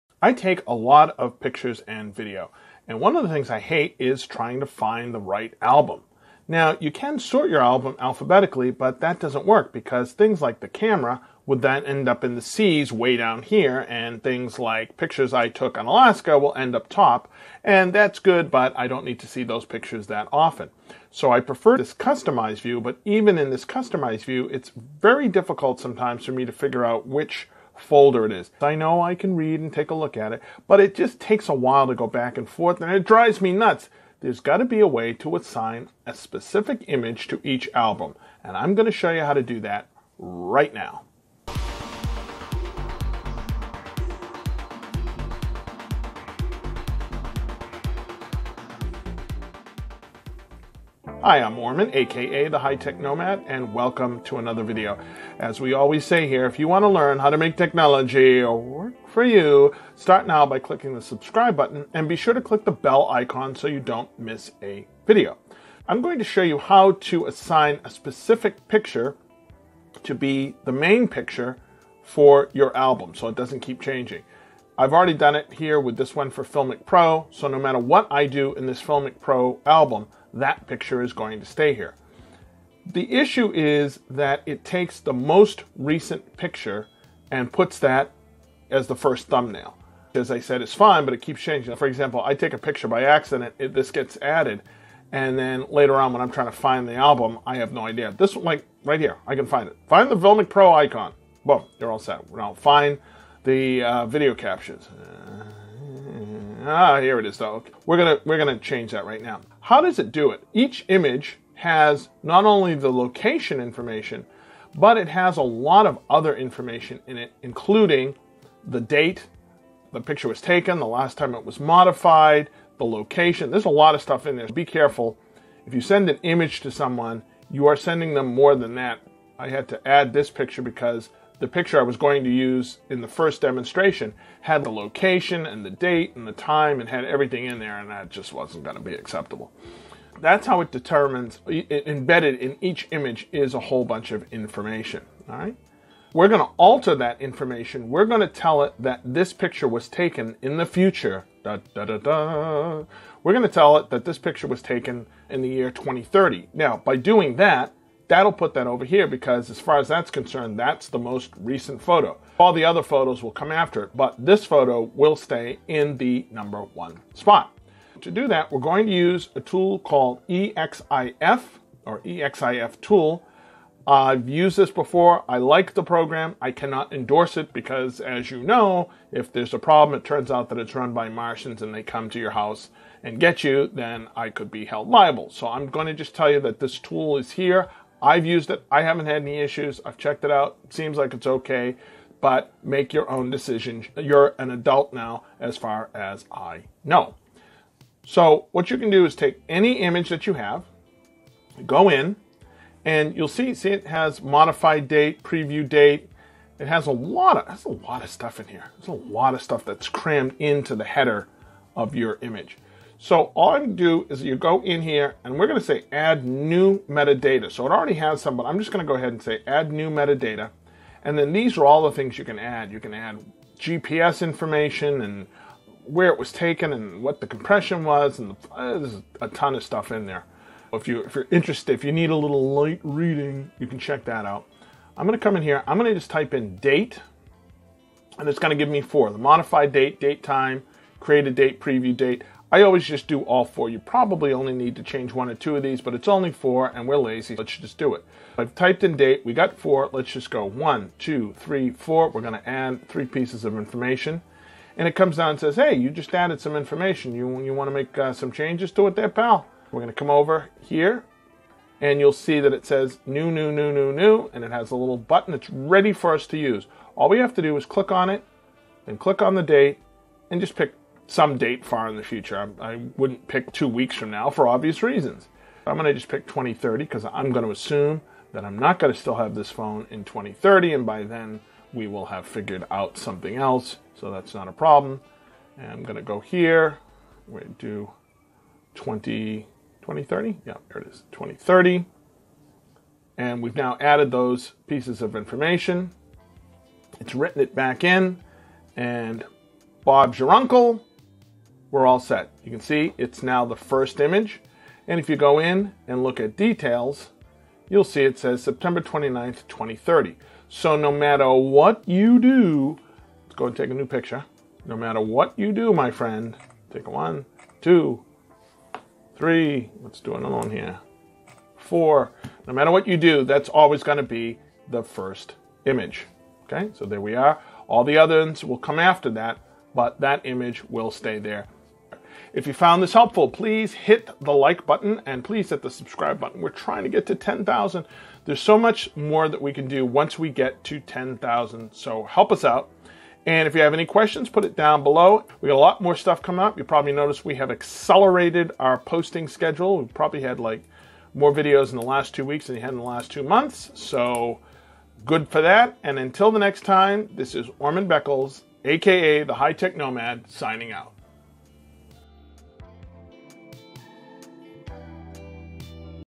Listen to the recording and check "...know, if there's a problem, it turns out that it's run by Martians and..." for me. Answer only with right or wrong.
right.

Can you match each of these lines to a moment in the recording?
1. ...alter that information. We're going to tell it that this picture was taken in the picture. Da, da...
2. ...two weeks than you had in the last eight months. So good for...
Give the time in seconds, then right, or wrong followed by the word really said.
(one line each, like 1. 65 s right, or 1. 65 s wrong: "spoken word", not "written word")
1. 146 s wrong: "future", not "picture"
2. 352 s wrong: "two", not "eight".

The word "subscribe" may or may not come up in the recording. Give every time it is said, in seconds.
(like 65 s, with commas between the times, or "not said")
61 s, 335 s.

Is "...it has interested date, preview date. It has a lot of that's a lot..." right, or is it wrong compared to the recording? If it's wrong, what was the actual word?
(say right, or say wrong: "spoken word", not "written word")
wrong: "modified", not "interested".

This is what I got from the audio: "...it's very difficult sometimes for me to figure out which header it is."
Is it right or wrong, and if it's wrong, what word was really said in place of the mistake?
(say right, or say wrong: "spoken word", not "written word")
wrong: "folder", not "header".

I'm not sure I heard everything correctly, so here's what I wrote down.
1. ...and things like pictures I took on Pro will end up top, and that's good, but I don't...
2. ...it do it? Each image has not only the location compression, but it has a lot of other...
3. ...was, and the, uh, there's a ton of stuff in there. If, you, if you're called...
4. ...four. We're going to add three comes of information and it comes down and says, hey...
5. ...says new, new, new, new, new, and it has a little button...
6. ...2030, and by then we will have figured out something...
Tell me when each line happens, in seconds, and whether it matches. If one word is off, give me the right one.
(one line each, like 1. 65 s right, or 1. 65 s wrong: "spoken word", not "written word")
1. 13 s wrong: "Alaska", not "Pro"
2. 109 s wrong: "information", not "compression"
3. 227 s wrong: "interested", not "called"
4. 251 s wrong: "pieces", not "comes"
5. 262 s right
6. 280 s right.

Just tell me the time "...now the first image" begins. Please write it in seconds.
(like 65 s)
303 s.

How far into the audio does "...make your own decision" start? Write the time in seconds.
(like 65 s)
192 s.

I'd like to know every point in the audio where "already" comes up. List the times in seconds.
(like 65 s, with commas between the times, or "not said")
74 s, 217 s.